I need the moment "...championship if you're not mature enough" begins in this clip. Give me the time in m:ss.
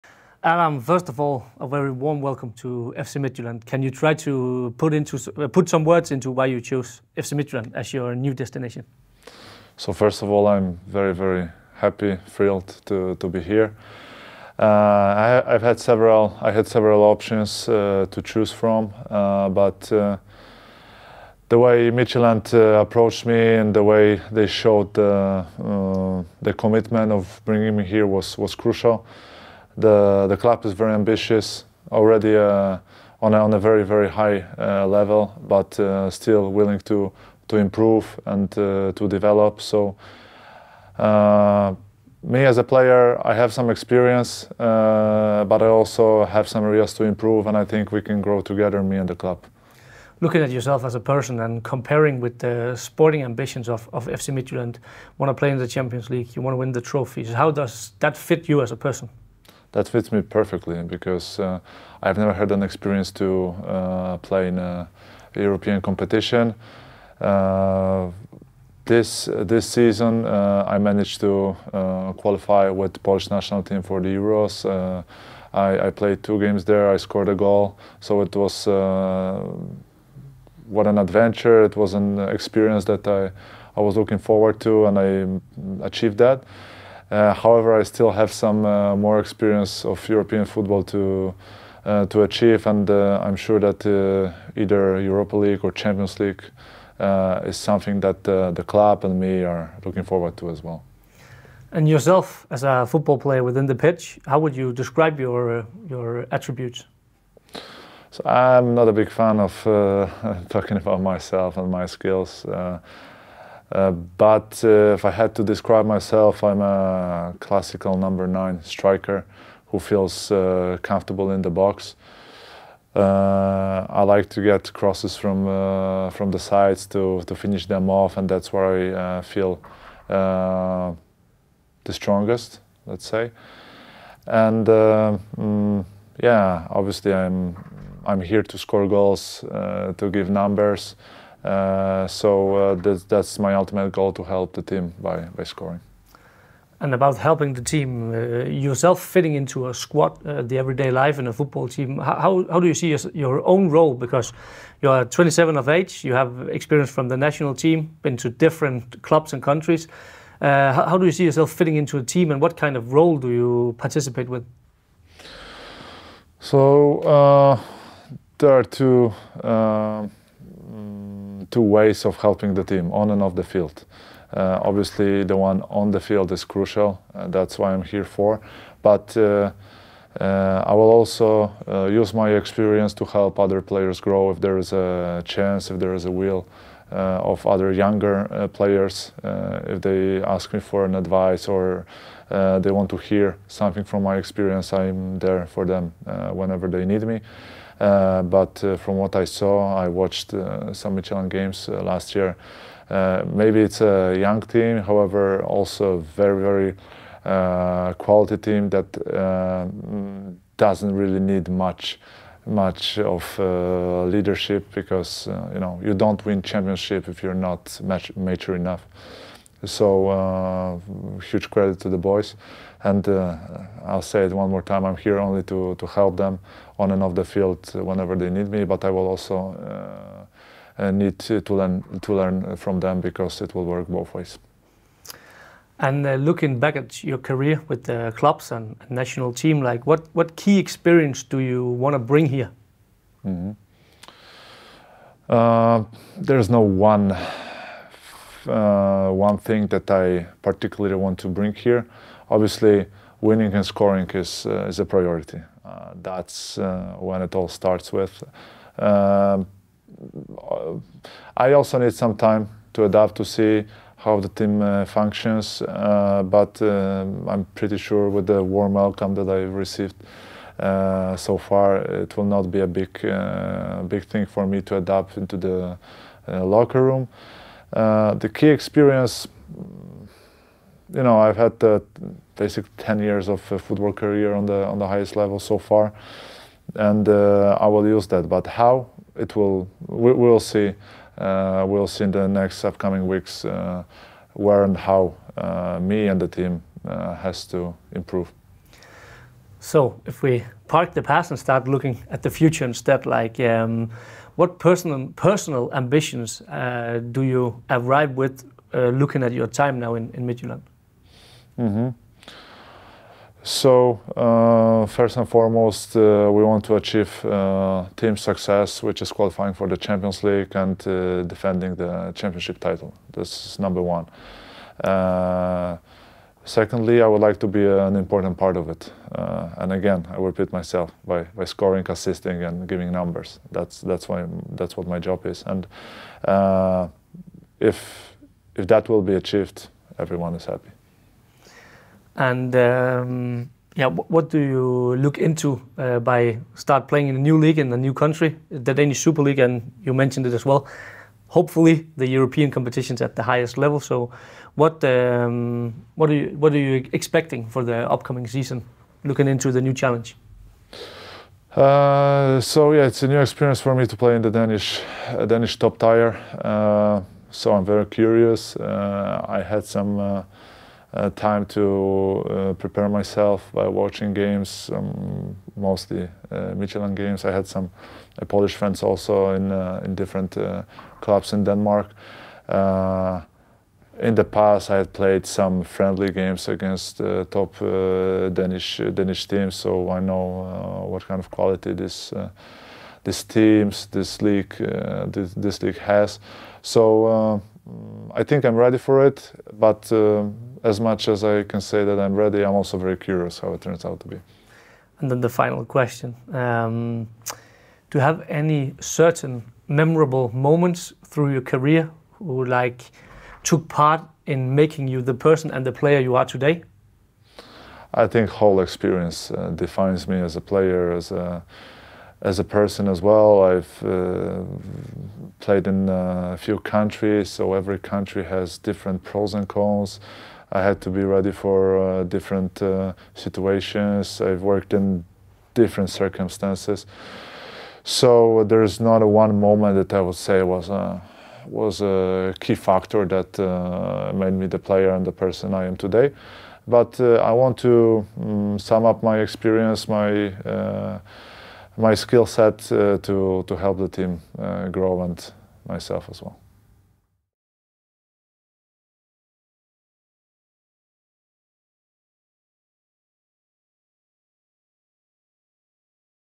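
3:36.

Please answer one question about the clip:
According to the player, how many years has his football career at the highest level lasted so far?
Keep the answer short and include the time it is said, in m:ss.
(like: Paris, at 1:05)
10 years, at 4:42.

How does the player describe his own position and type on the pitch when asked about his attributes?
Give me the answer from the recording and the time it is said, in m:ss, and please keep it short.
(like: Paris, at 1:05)
Classical number nine, at 1:57.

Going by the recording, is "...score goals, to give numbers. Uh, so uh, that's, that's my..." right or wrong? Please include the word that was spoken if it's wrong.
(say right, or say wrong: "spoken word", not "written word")
right.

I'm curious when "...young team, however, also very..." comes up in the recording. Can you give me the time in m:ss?
3:24.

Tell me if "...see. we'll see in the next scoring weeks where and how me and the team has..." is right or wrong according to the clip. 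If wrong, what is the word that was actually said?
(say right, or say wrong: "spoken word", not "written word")
wrong: "upcoming", not "scoring".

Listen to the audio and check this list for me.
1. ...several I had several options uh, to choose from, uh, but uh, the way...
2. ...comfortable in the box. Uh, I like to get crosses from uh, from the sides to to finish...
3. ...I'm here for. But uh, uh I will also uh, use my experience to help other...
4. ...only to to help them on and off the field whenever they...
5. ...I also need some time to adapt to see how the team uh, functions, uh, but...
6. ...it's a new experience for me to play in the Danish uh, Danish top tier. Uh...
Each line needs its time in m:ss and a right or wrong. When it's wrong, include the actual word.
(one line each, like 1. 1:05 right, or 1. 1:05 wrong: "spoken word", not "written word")
1. 0:15 right
2. 2:00 right
3. 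2:57 right
4. 3:45 right
5. 4:21 right
6. 6:02 right.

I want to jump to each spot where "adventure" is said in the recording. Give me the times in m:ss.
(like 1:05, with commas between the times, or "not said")
1:20.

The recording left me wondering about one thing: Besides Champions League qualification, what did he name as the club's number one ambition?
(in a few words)
Defending the championship title.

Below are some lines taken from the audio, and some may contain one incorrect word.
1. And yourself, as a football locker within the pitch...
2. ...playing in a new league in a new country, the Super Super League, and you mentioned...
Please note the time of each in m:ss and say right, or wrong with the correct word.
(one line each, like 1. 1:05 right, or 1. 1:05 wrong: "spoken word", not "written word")
1. 1:41 wrong: "player", not "locker"
2. 5:46 wrong: "Danish", not "Super".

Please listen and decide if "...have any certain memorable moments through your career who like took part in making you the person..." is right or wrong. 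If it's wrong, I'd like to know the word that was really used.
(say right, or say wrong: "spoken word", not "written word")
right.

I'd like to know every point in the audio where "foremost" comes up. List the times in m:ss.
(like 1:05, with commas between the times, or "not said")
5:15.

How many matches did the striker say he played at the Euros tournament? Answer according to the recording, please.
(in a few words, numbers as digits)
2.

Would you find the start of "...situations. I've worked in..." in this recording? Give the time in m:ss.
7:13.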